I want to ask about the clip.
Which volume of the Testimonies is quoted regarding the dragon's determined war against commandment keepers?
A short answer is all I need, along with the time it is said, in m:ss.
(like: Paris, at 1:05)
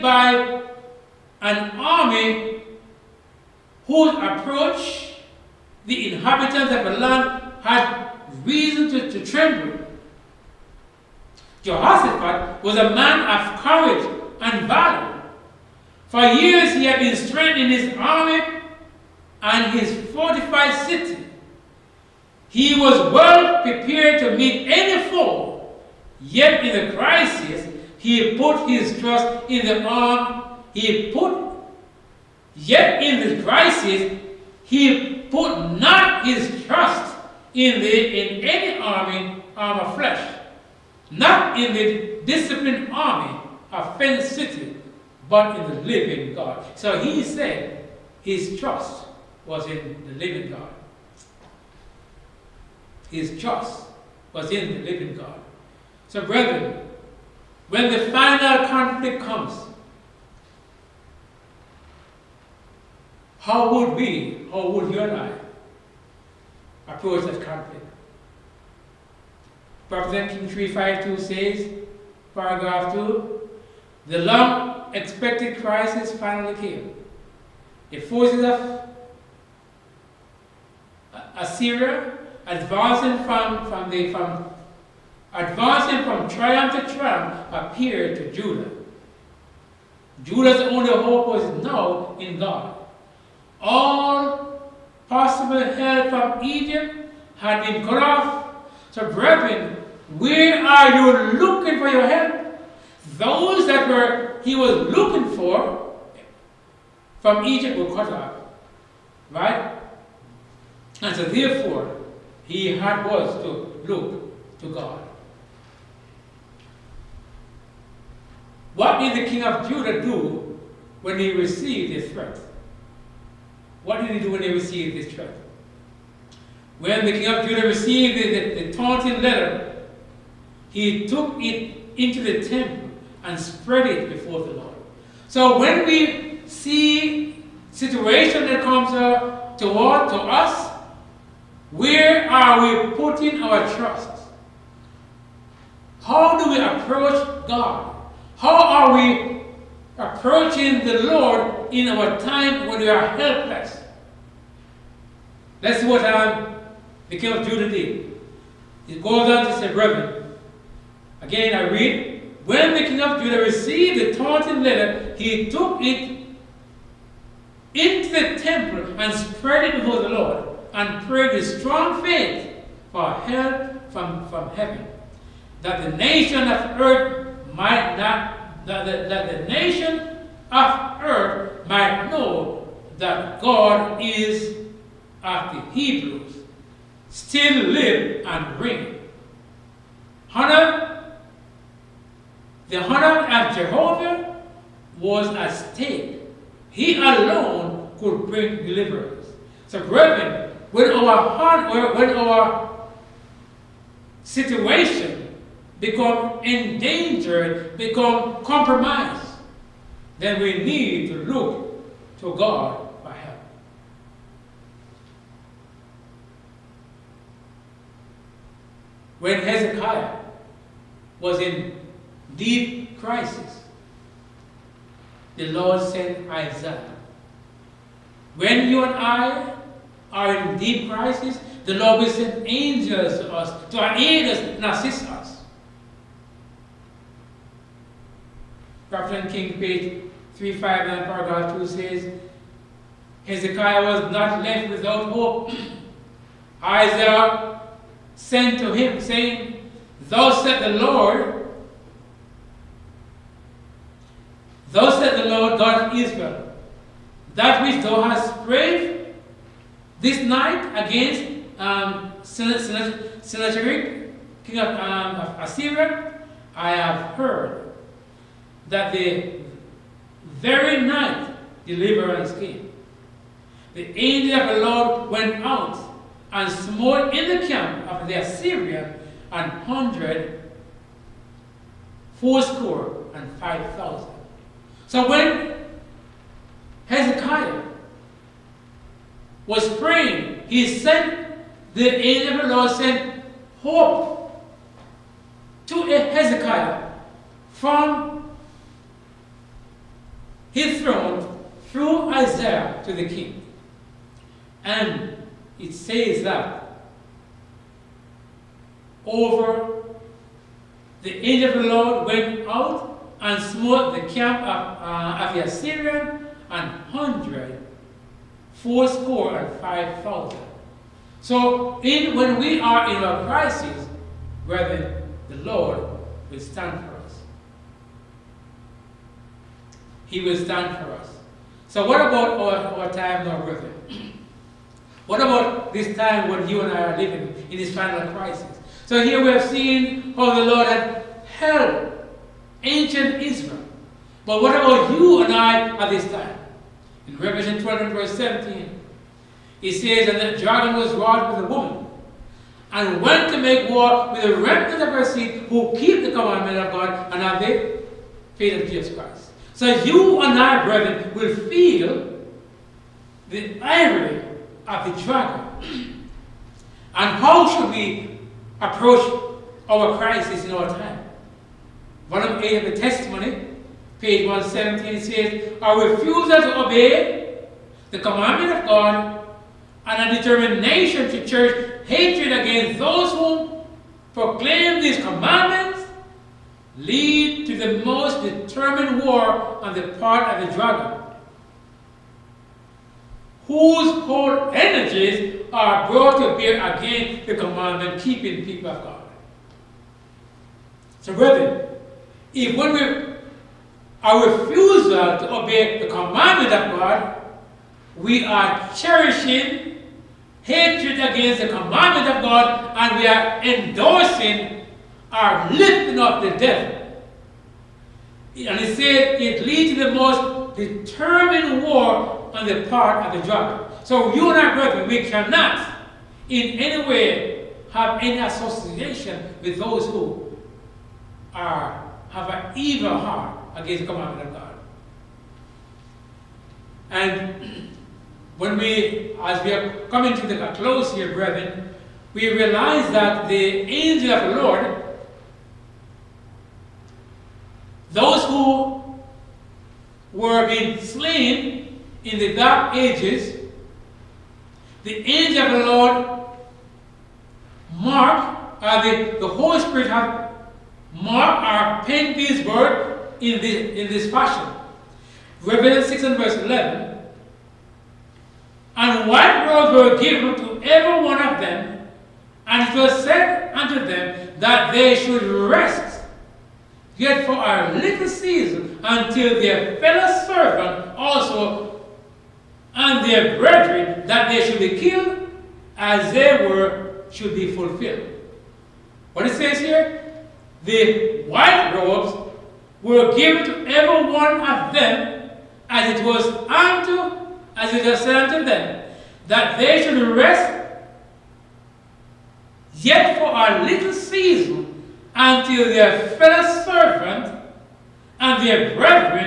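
Volume 8, at 6:12.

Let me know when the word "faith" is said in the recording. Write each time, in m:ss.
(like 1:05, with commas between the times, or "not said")
2:52, 5:58.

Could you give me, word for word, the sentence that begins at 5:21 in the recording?
So in, when we are in a crisis, brethren, the Lord will stand for us.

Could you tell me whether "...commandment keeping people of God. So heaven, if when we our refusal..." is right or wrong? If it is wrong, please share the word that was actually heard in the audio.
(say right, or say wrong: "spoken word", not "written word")
wrong: "brethren", not "heaven".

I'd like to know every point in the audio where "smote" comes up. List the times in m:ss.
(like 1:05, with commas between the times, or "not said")
4:36, 5:13.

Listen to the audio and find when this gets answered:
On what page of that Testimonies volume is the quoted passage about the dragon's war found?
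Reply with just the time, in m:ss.
6:14.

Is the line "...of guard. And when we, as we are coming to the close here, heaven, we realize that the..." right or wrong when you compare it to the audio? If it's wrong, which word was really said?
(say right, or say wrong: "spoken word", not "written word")
wrong: "brethren", not "heaven".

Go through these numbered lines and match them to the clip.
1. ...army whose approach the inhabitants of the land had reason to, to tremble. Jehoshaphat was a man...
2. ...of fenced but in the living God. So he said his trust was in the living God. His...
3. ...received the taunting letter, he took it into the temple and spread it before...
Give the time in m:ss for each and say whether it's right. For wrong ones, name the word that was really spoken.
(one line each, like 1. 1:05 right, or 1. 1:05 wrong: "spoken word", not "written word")
1. 0:01 right
2. 0:43 right
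3. 2:43 right.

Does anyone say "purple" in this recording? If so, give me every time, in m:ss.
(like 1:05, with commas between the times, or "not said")
not said.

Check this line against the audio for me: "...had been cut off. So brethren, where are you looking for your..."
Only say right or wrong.
right.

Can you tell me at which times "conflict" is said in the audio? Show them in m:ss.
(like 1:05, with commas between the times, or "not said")
0:58, 1:07.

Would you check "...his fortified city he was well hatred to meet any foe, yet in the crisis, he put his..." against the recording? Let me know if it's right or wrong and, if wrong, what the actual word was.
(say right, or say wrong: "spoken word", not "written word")
wrong: "prepared", not "hatred".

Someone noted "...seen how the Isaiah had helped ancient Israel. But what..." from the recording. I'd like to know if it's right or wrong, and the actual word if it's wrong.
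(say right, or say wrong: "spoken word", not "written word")
wrong: "Lord", not "Isaiah".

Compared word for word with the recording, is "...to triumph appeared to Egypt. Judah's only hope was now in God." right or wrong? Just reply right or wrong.
wrong.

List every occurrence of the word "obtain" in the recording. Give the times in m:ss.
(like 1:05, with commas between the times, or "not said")
not said.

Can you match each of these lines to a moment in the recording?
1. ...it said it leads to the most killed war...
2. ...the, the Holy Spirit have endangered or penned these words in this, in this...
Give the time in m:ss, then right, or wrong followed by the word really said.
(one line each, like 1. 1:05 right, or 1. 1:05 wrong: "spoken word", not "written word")
1. 6:58 wrong: "determined", not "killed"
2. 7:38 wrong: "marked", not "endangered".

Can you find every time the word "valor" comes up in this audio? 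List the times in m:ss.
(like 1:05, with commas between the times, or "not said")
0:14.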